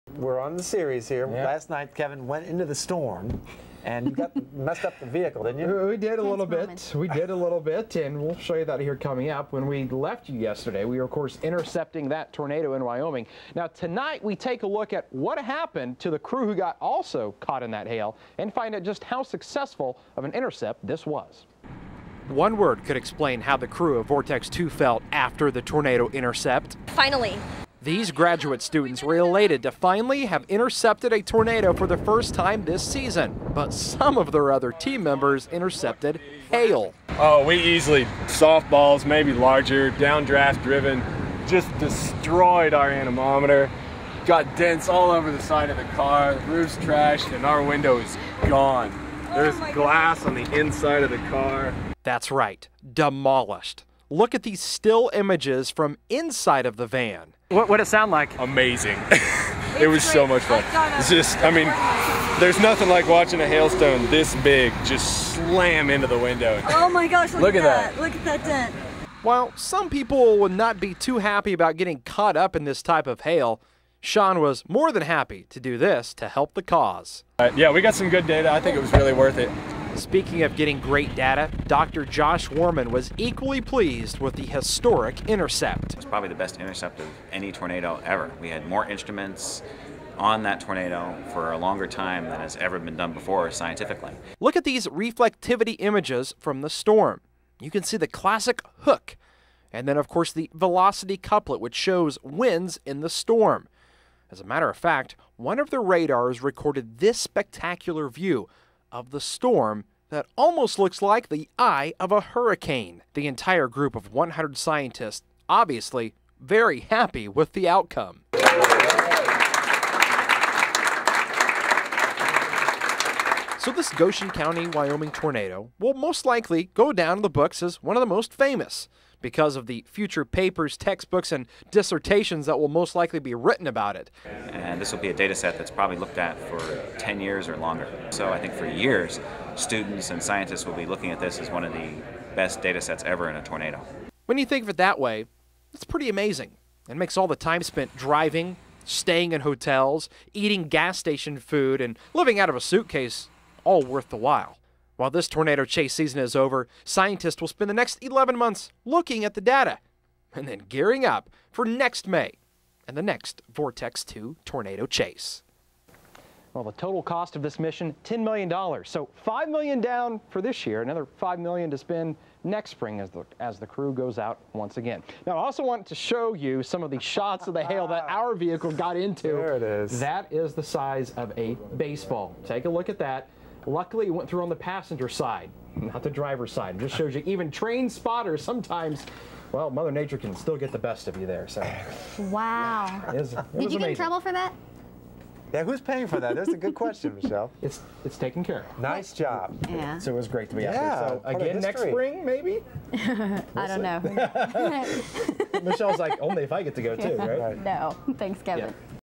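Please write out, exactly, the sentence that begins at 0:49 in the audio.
There's oh glass on the inside of the car.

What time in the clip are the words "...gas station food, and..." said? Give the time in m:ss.
2:30.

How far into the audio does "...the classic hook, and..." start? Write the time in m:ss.
1:37.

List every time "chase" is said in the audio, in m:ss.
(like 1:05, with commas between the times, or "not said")
2:35, 2:44.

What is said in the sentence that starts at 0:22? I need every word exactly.
One word could explain how the crew of Vortex 2 felt after the tornado intercept.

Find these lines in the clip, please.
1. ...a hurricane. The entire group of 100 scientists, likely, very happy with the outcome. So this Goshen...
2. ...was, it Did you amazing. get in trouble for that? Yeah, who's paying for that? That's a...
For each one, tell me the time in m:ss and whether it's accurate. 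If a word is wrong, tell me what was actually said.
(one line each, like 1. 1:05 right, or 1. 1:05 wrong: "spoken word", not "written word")
1. 1:52 wrong: "obviously", not "likely"
2. 3:13 right.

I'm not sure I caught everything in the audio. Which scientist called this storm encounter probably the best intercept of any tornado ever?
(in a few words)
Dr. Josh Wurman.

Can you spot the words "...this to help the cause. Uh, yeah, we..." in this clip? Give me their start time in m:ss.
1:15.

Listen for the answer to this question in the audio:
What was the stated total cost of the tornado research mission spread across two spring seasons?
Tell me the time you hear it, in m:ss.
2:48.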